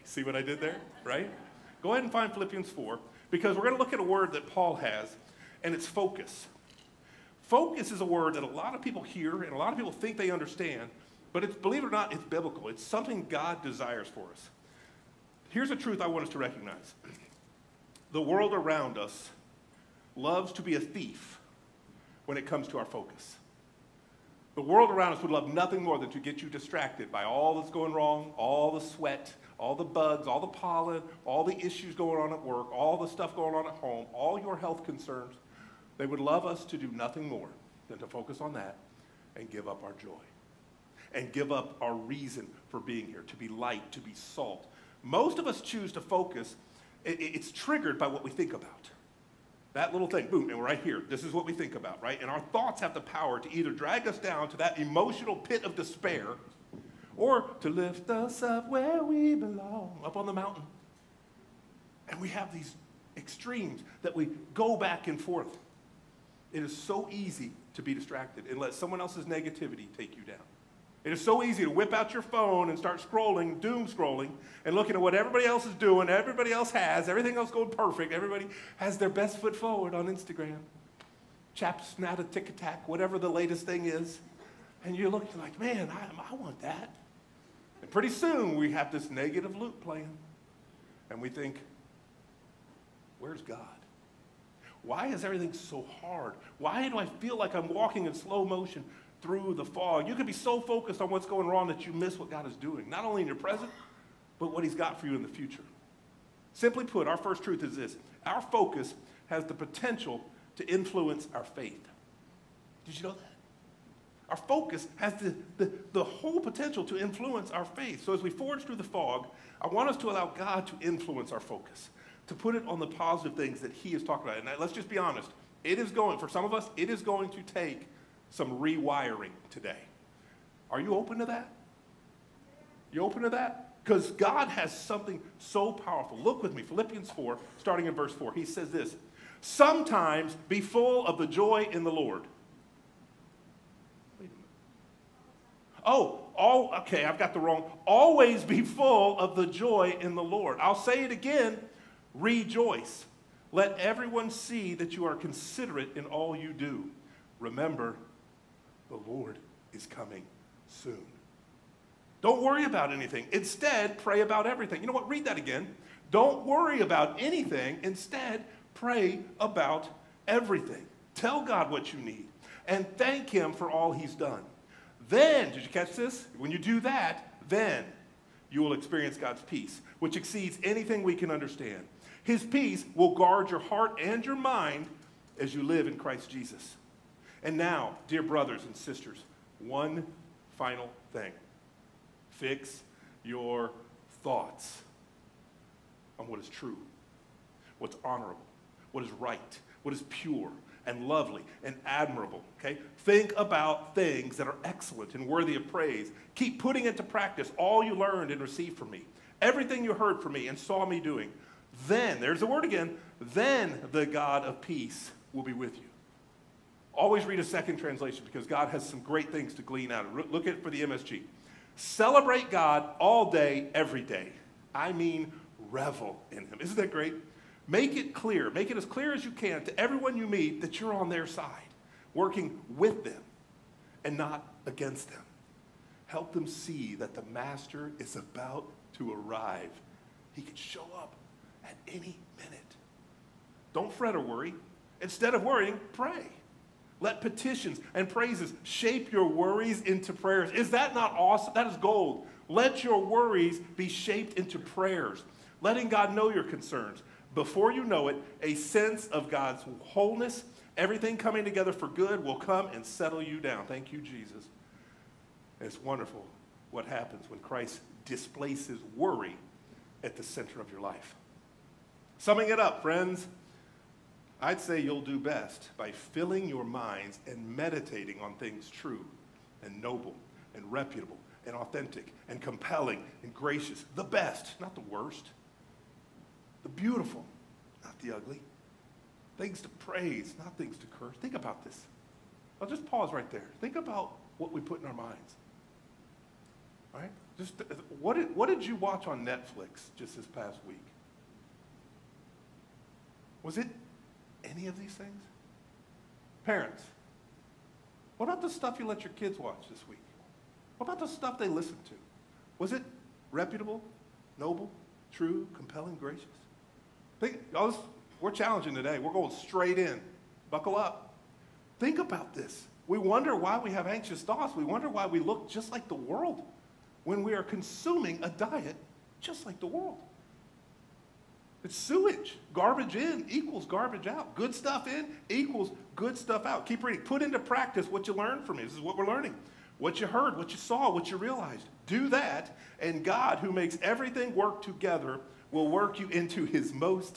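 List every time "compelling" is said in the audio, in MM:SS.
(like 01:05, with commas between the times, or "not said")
04:42, 05:15.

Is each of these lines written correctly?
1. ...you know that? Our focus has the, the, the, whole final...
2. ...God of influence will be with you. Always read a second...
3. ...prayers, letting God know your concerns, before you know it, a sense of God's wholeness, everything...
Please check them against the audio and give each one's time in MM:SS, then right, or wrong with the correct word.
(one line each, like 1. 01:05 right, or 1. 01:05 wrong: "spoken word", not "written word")
1. 01:52 wrong: "potential", not "final"
2. 03:34 wrong: "peace", not "influence"
3. 04:14 right.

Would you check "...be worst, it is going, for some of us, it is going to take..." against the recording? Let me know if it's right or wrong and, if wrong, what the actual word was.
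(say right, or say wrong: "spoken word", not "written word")
wrong: "honest", not "worst".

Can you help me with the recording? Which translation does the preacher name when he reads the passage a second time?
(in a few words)
MSG.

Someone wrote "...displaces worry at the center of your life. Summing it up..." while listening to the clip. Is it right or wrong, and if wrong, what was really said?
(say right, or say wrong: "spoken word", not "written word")
right.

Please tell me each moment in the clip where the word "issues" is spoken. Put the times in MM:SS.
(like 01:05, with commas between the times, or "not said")
00:31.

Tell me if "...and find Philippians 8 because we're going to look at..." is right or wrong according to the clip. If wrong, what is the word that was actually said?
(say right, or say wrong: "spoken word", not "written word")
wrong: "4", not "8".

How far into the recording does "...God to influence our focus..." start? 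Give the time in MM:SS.
02:00.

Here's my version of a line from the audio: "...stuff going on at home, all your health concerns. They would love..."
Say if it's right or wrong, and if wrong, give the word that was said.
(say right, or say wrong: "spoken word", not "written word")
right.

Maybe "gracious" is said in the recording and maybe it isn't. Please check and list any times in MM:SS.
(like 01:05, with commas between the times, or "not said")
04:43, 05:15.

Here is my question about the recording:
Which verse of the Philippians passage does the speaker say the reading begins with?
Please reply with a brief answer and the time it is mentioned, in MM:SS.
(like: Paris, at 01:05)
verse 4, at 02:17.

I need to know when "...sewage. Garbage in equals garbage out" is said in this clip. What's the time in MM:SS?
05:31.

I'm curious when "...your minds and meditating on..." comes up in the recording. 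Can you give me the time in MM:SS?
04:36.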